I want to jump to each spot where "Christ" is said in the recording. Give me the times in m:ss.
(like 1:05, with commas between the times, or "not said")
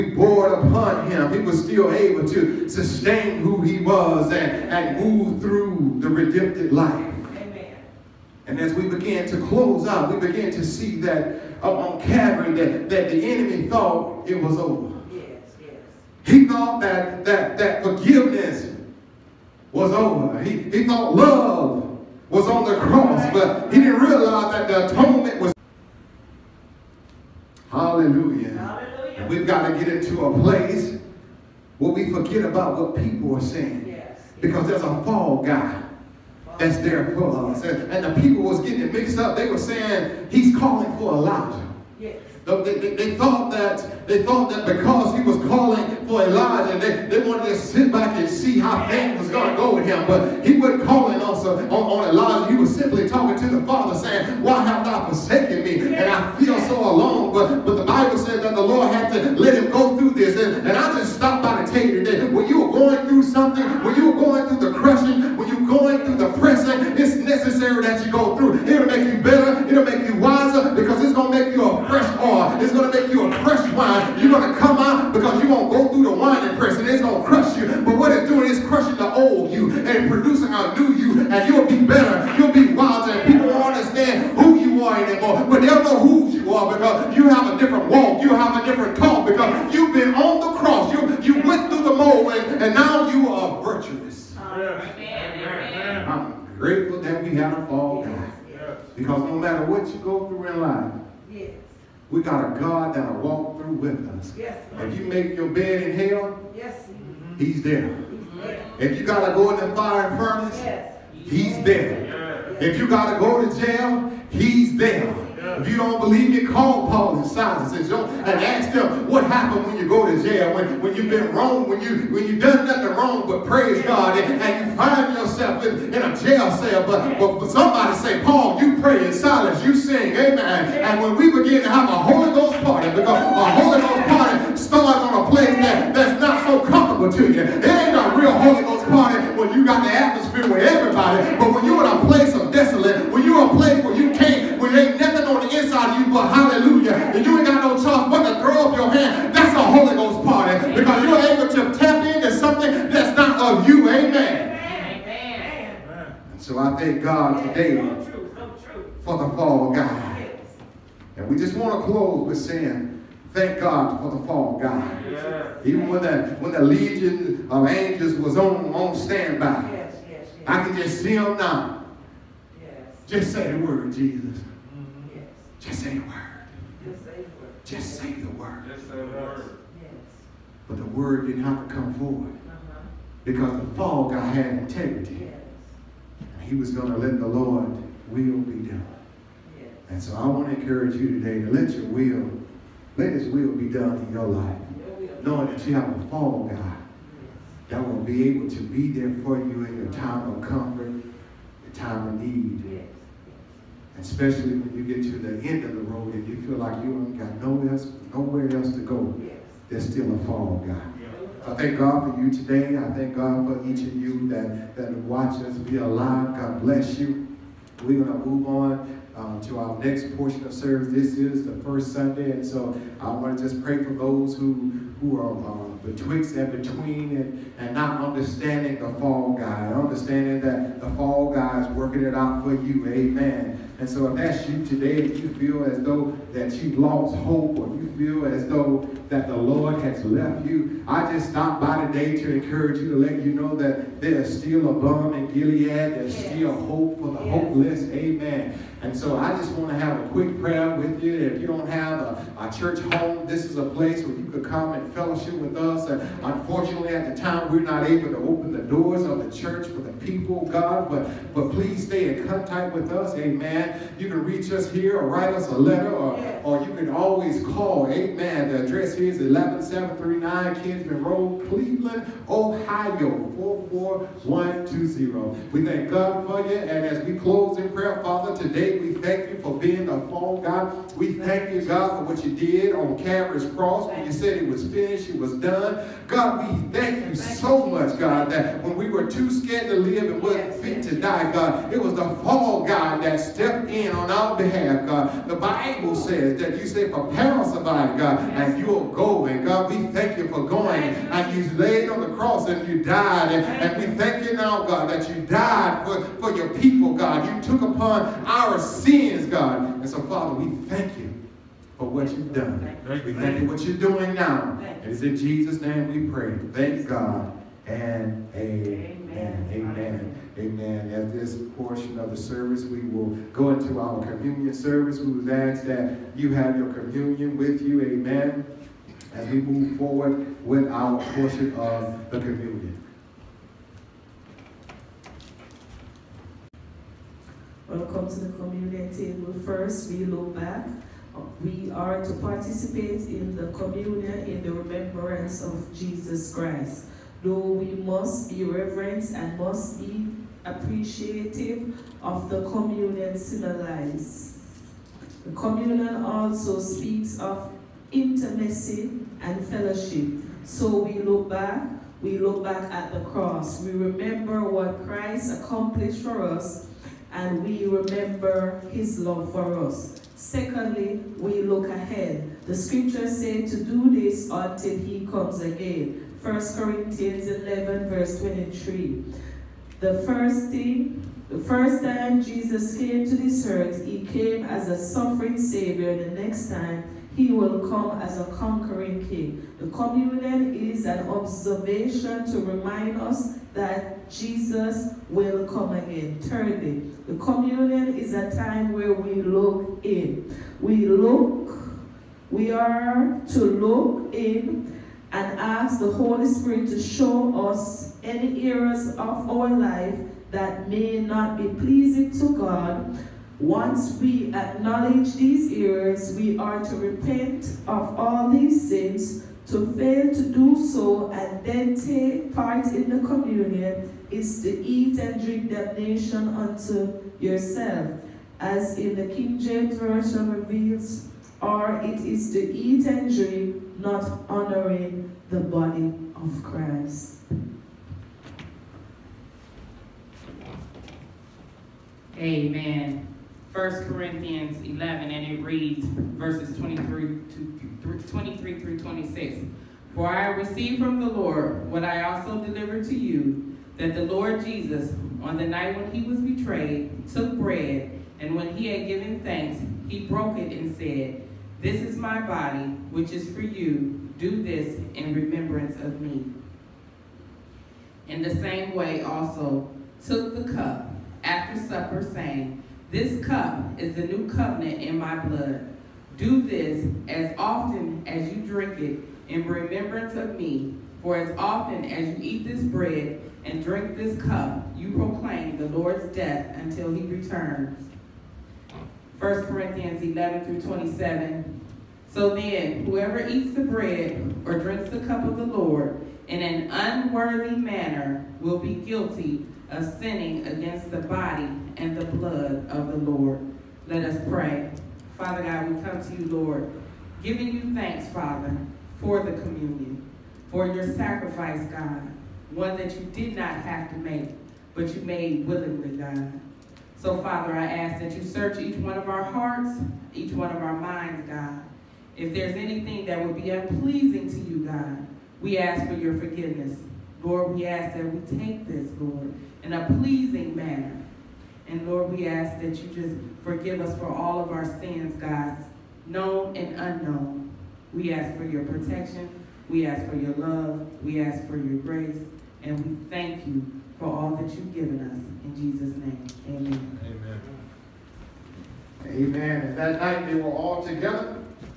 5:46, 6:04, 7:16.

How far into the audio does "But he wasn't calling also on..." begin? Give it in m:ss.
0:50.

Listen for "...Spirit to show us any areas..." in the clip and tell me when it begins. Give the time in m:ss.
6:46.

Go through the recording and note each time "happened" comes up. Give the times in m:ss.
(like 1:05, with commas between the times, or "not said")
1:59.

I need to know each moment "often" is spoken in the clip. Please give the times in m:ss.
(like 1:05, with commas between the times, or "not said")
7:57, 8:01.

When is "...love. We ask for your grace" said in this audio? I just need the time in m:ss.
9:00.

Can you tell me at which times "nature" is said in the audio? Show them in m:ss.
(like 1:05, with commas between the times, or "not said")
not said.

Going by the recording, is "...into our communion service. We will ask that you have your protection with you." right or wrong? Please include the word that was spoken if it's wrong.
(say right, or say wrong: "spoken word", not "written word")
wrong: "communion", not "protection".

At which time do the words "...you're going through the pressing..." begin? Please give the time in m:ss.
1:05.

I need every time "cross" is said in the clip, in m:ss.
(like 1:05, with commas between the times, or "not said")
0:22, 4:43, 5:02, 6:02.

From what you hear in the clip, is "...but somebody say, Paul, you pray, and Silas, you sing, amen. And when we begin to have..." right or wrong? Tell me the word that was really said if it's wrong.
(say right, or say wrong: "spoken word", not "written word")
right.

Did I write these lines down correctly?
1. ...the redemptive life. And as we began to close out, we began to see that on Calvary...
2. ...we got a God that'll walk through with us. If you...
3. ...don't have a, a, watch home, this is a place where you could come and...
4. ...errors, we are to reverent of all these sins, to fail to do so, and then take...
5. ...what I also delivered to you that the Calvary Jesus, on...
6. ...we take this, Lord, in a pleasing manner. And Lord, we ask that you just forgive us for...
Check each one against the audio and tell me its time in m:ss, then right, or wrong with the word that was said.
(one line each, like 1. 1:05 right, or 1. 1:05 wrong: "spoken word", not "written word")
1. 0:05 right
2. 1:42 right
3. 4:11 wrong: "church", not "watch"
4. 6:55 wrong: "repent", not "reverent"
5. 7:31 wrong: "Lord", not "Calvary"
6. 8:48 right.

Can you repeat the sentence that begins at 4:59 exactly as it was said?
And God, we thank you for going.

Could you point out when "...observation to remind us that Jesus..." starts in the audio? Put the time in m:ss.
6:31.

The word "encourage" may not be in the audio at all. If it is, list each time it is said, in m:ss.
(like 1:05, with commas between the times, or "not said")
3:10, 4:02.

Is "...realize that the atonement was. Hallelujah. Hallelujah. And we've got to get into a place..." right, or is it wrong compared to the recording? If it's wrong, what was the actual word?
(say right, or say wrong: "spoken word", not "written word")
right.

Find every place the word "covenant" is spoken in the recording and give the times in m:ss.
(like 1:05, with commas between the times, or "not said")
7:54.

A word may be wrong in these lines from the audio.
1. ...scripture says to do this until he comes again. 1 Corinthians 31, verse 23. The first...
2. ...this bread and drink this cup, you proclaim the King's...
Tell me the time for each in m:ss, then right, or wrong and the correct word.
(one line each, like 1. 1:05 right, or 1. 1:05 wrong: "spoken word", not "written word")
1. 6:12 wrong: "11", not "31"
2. 8:02 wrong: "Lord", not "King".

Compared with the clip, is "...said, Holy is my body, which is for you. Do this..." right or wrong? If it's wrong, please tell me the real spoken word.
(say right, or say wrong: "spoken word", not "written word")
wrong: "This", not "Holy".